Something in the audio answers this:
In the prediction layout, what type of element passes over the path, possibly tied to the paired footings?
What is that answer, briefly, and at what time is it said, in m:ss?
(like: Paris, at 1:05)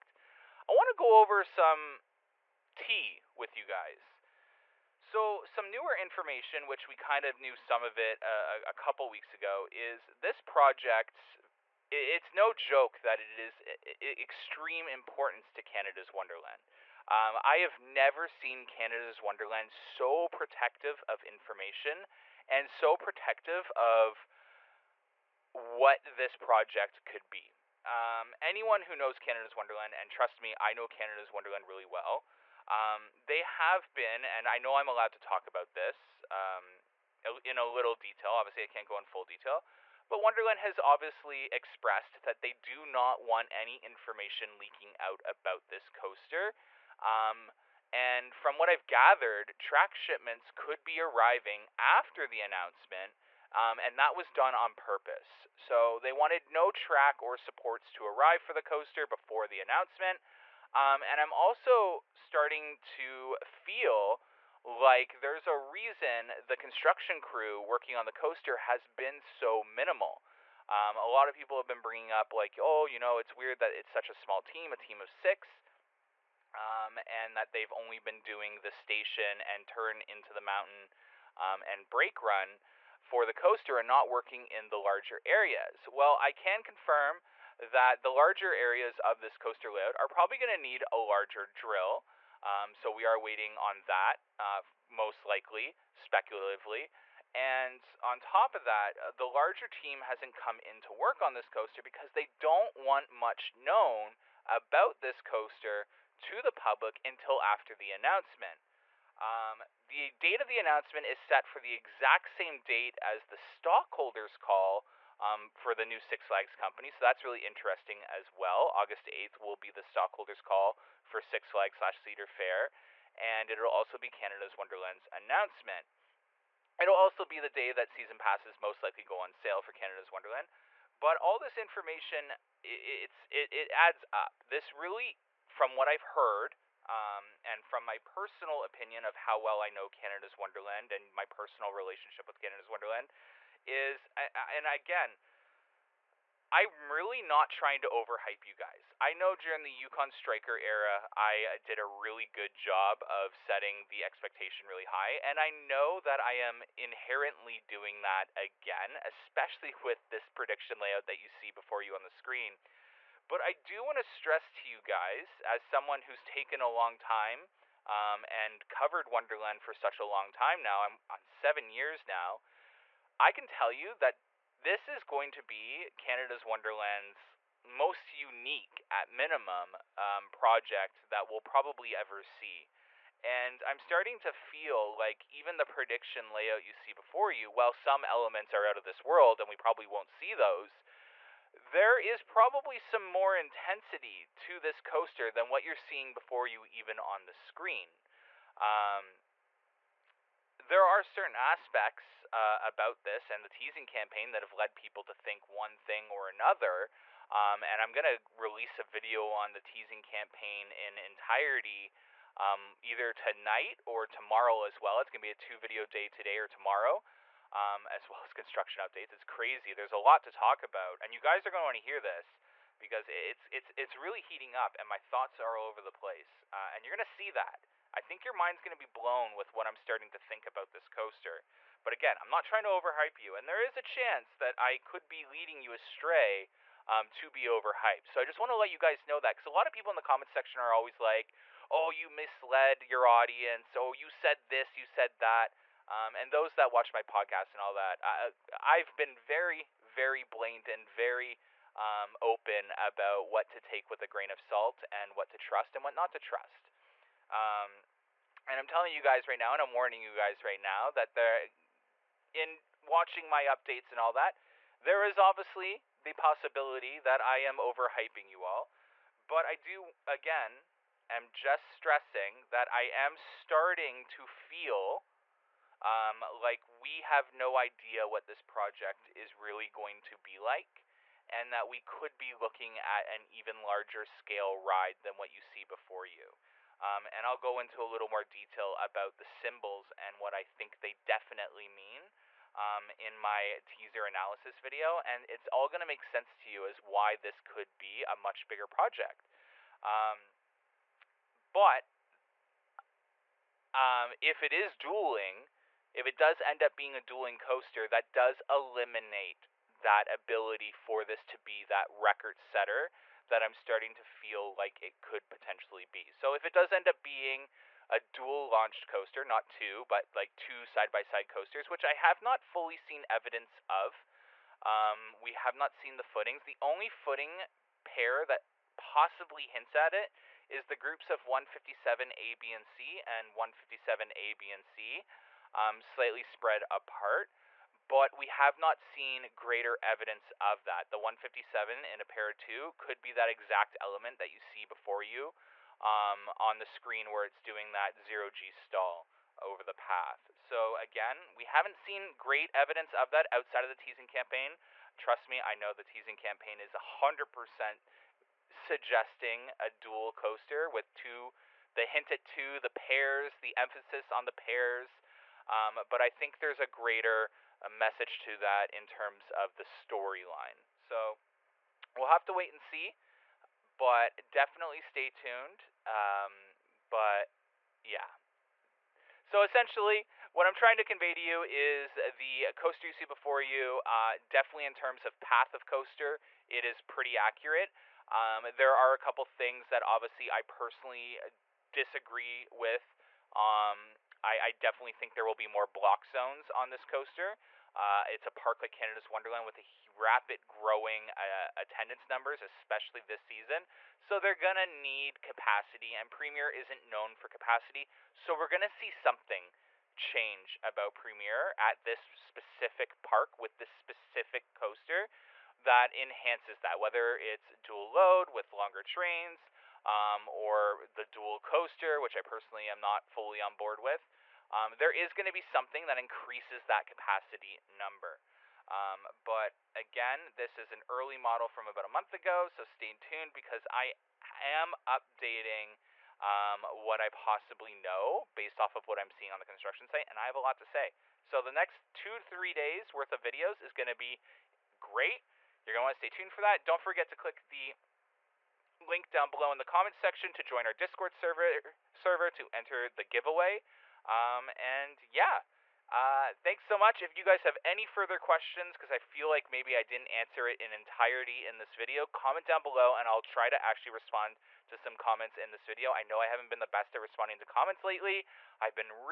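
zero G stall, at 5:47.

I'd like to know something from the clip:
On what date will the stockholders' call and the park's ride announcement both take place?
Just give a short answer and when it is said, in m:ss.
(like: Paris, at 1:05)
August 8th, at 1:58.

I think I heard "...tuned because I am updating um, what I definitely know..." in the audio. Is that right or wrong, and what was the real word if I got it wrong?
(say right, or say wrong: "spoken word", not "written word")
wrong: "possibly", not "definitely".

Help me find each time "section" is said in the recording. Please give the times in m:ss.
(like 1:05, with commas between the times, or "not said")
4:00, 7:29.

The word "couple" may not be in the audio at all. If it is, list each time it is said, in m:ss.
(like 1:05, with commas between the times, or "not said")
0:08, 6:28.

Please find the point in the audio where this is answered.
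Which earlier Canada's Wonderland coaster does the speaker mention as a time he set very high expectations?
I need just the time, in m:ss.
2:29.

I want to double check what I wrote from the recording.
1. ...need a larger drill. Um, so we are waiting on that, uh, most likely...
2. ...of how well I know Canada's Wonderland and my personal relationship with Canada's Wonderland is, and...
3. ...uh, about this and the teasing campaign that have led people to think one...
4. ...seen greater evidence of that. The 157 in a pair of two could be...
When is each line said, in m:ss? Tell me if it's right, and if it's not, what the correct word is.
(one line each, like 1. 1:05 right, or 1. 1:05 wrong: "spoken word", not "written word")
1. 1:30 right
2. 2:19 right
3. 3:22 right
4. 5:38 right.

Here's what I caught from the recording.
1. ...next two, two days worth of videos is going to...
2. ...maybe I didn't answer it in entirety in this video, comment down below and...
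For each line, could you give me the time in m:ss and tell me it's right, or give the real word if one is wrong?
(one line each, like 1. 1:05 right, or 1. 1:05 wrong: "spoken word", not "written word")
1. 7:21 wrong: "three", not "two"
2. 7:39 right.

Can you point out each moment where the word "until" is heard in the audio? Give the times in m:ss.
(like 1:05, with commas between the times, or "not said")
1:47.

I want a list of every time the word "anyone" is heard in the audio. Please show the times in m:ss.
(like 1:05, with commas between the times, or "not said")
0:28.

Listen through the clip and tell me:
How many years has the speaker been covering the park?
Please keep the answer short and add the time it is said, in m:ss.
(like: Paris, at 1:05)
7, at 2:51.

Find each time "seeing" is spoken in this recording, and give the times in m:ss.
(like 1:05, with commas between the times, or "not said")
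3:15, 7:19.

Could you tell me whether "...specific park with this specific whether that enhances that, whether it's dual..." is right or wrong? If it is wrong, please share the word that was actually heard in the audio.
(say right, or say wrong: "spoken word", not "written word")
wrong: "coaster", not "whether".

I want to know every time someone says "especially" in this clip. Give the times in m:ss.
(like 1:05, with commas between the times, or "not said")
2:39, 6:42.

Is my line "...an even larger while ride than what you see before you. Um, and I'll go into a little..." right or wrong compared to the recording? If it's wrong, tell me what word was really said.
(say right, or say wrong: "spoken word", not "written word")
wrong: "scale", not "while".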